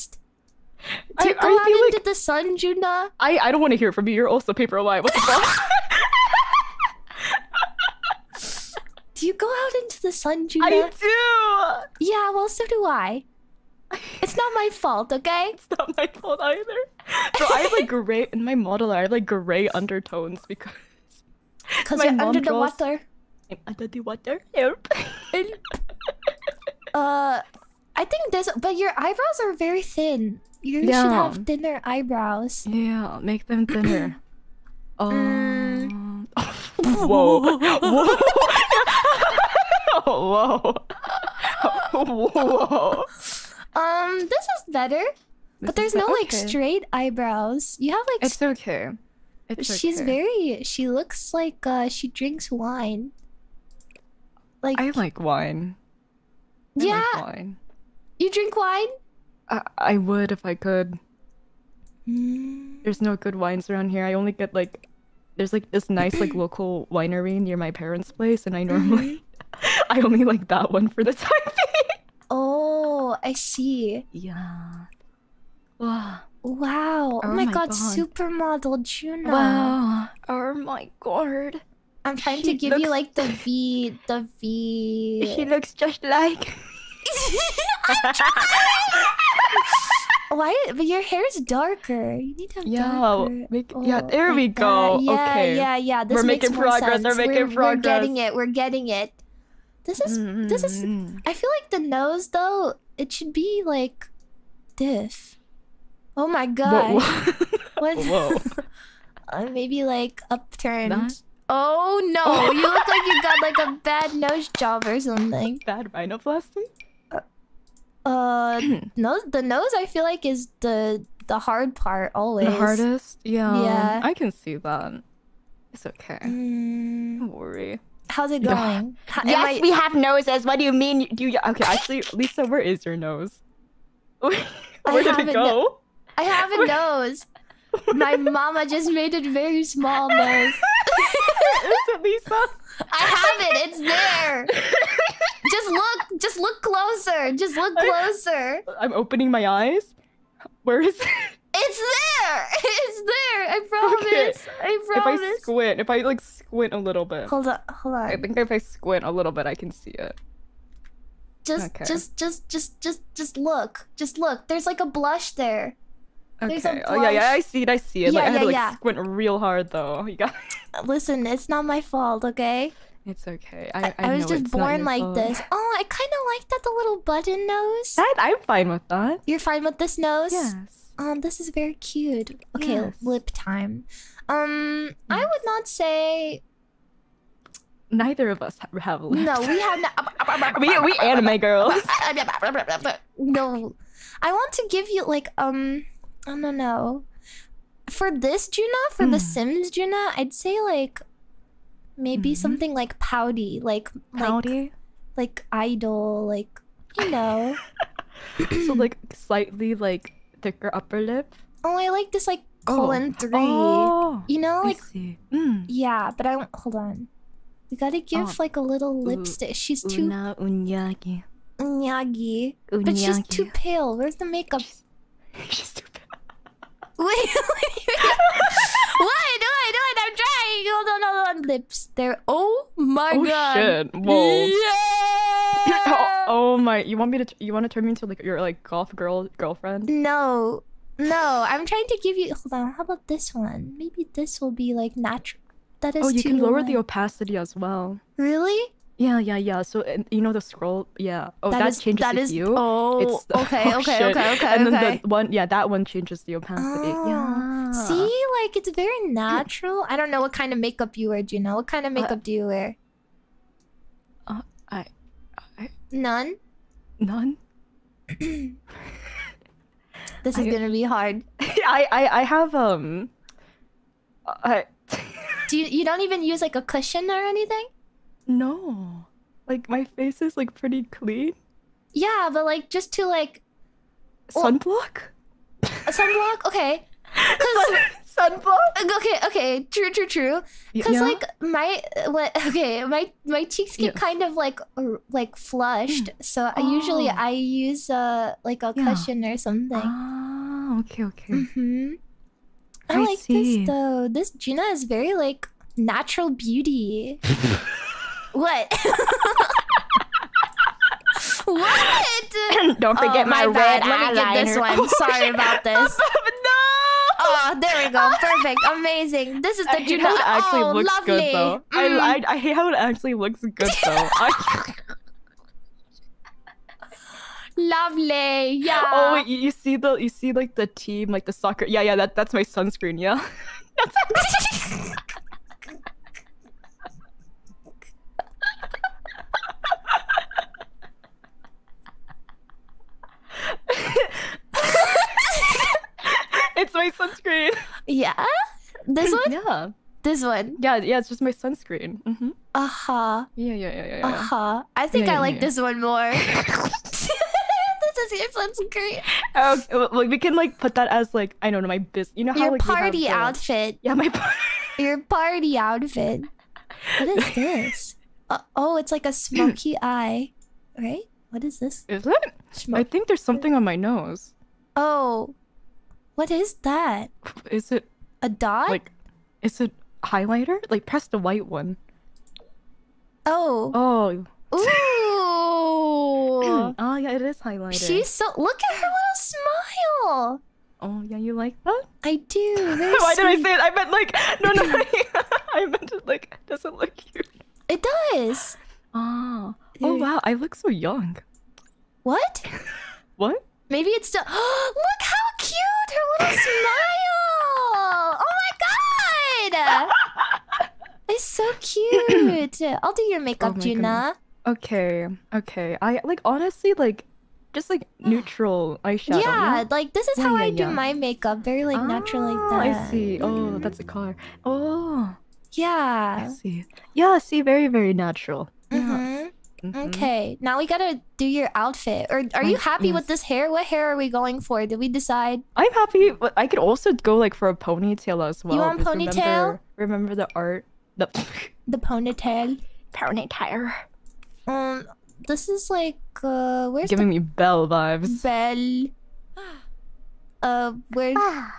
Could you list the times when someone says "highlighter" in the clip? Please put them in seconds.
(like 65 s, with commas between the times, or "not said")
380 s, 387 s.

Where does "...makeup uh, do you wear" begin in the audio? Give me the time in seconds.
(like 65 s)
261 s.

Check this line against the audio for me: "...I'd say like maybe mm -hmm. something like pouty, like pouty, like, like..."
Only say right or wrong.
right.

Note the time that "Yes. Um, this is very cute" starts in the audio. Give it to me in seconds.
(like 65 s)
180 s.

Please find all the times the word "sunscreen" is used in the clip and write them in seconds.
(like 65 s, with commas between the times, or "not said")
332 s, 346 s, 351 s, 358 s.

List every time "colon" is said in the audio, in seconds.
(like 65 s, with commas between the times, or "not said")
212 s.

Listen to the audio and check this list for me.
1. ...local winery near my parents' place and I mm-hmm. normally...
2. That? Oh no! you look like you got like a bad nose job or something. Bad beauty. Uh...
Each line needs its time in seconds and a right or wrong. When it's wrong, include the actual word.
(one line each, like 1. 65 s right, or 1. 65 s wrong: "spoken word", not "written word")
1. 66 s right
2. 110 s wrong: "rhinoplasty", not "beauty".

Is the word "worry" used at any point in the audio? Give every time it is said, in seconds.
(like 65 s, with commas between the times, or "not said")
127 s.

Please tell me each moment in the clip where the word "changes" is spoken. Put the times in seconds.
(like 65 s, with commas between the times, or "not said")
251 s, 255 s.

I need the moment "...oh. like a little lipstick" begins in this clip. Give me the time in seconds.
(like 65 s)
218 s.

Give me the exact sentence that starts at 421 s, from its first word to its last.
Very like ah, natural like that.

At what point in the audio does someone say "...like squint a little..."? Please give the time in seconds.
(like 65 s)
156 s.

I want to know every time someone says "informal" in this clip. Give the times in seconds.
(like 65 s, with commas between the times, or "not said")
not said.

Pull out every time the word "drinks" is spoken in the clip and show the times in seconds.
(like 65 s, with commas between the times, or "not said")
52 s, 58 s.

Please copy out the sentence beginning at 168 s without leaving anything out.
Yeah, like, I had yeah, to like yeah.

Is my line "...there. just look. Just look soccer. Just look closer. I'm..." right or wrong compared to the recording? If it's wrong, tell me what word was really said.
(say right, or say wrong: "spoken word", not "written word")
wrong: "closer", not "soccer".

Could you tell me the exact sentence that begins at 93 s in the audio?
Make, oh, yeah, there like we go.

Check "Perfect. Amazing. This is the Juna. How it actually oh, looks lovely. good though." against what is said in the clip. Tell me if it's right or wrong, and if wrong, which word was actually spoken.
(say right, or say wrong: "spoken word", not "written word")
right.